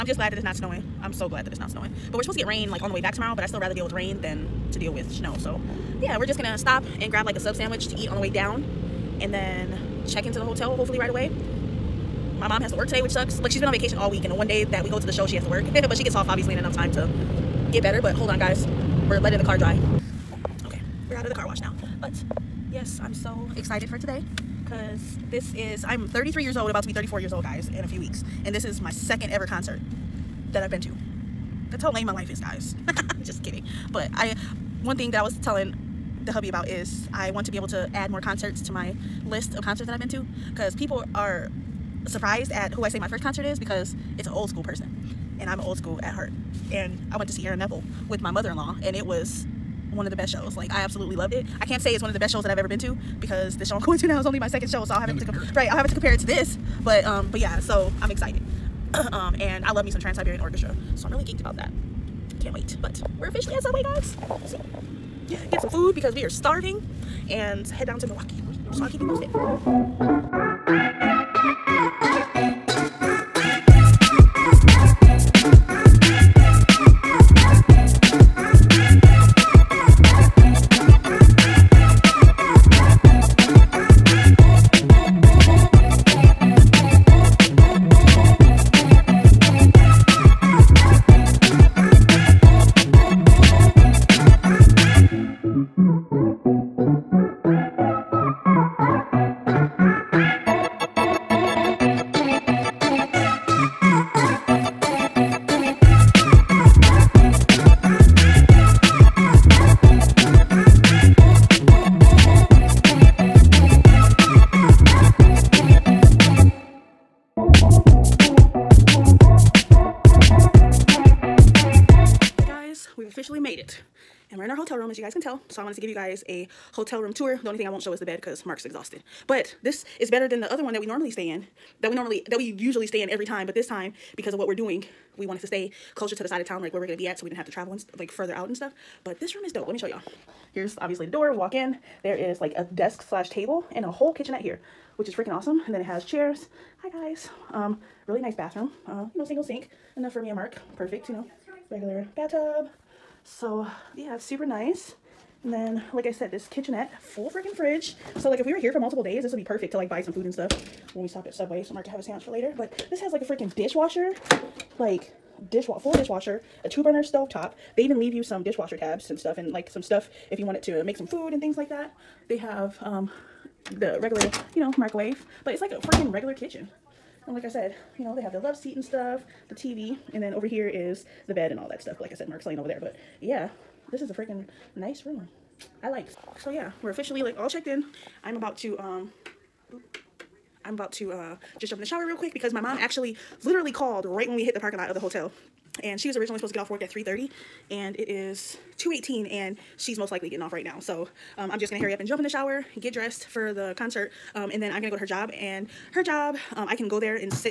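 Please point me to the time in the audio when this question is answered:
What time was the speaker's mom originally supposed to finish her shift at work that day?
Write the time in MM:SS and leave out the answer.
03:16.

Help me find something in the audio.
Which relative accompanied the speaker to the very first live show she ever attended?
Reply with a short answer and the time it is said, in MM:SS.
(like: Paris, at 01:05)
mother-in-law, at 00:48.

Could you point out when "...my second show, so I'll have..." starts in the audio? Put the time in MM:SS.
00:54.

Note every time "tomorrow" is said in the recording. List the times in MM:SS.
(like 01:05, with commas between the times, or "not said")
00:03.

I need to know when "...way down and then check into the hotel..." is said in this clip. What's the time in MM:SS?
00:08.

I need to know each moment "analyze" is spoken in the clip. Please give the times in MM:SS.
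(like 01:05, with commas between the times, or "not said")
not said.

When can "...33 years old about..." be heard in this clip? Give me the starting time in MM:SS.
00:26.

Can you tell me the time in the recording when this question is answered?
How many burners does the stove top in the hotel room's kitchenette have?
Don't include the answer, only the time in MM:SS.
02:46.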